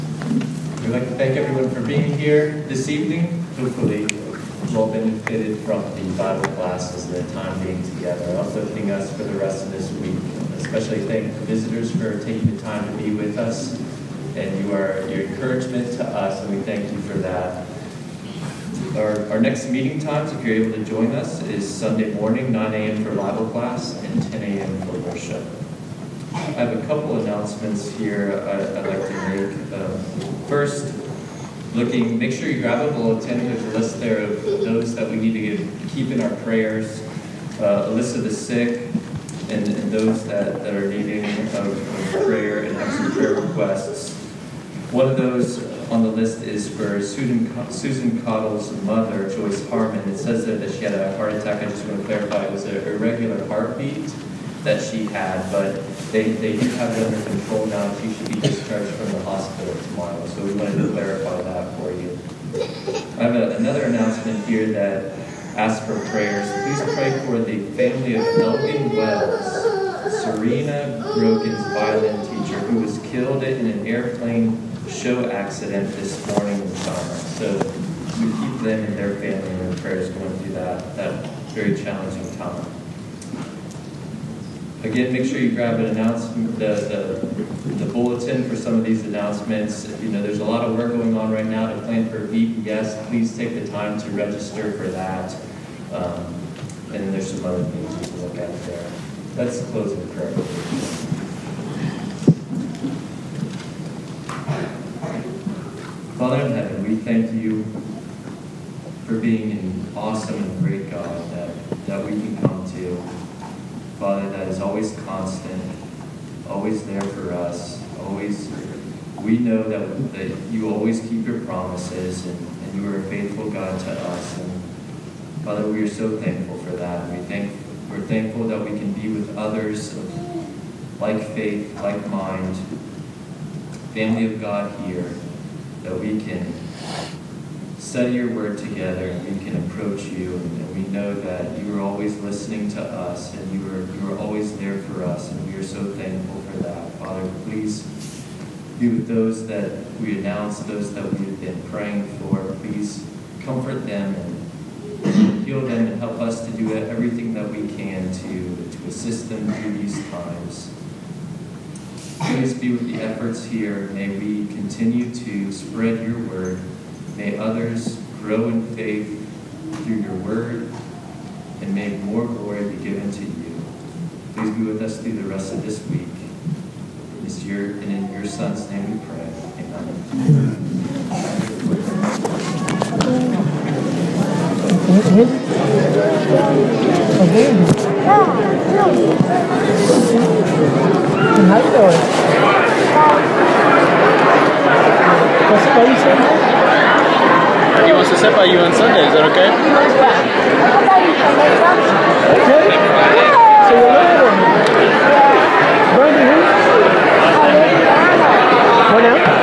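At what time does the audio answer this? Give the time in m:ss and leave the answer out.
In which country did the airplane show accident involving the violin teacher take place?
1:16.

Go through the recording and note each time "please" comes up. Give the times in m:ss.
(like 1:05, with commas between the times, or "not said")
1:06, 1:33, 2:27, 2:32, 2:42, 2:54.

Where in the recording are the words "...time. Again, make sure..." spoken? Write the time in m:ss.
1:22.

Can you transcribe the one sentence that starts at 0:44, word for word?
One of those on the list is for Susan, Susan Cottle's mother, Joyce Harmon.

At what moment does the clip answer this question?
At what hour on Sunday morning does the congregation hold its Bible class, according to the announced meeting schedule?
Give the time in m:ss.
0:22.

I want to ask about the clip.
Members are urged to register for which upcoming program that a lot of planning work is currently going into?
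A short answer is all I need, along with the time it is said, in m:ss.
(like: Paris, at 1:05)
VEEP, at 1:32.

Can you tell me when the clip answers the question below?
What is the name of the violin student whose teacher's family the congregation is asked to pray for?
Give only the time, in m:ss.
1:10.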